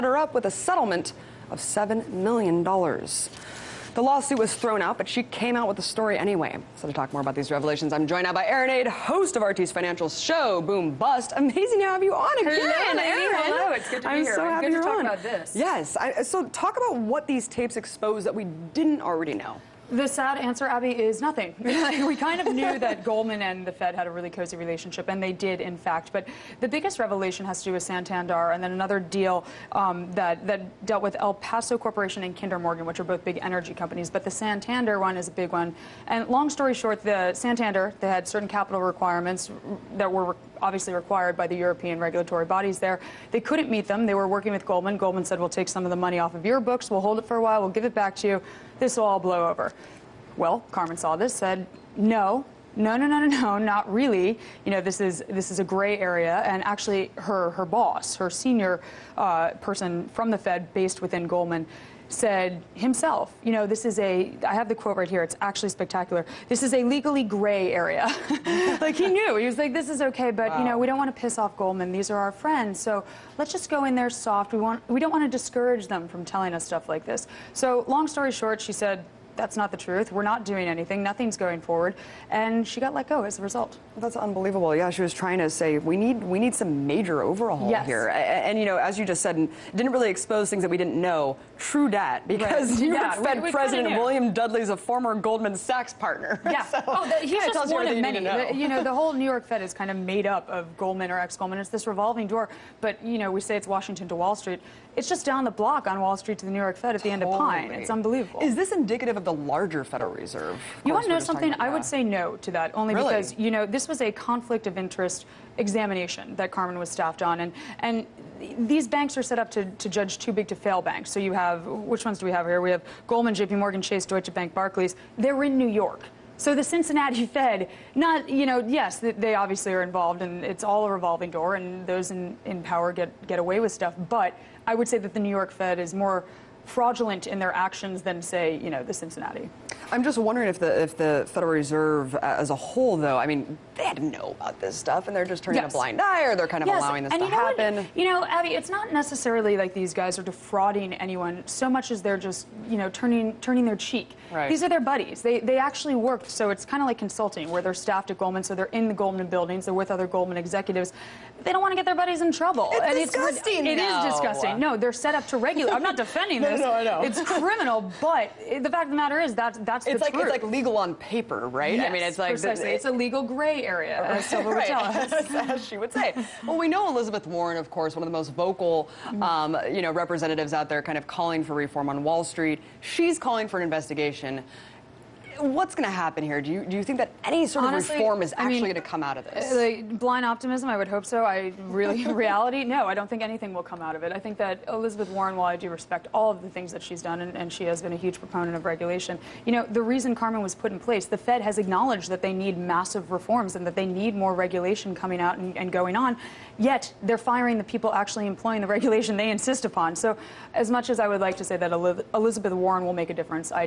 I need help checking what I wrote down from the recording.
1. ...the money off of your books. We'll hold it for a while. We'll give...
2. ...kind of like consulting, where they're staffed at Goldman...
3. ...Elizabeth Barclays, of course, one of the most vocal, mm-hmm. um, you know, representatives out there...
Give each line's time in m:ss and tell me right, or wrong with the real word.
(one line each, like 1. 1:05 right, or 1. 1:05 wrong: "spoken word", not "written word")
1. 0:45 right
2. 2:36 right
3. 2:56 wrong: "Warren", not "Barclays".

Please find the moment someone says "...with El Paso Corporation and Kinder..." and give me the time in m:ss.
0:31.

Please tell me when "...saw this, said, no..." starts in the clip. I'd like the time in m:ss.
0:50.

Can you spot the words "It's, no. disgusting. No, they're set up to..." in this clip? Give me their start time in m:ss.
2:43.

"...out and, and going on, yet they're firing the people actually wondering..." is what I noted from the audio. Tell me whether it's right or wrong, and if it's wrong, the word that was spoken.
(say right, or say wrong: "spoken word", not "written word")
wrong: "employing", not "wondering".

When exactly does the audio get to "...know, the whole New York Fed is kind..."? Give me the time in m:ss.
1:38.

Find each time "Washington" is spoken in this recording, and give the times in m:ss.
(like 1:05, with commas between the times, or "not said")
1:43.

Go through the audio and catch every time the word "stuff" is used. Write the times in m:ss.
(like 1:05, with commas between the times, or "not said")
1:16, 2:13, 2:24.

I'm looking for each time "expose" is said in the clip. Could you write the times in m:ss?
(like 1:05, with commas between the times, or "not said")
0:17, 1:30.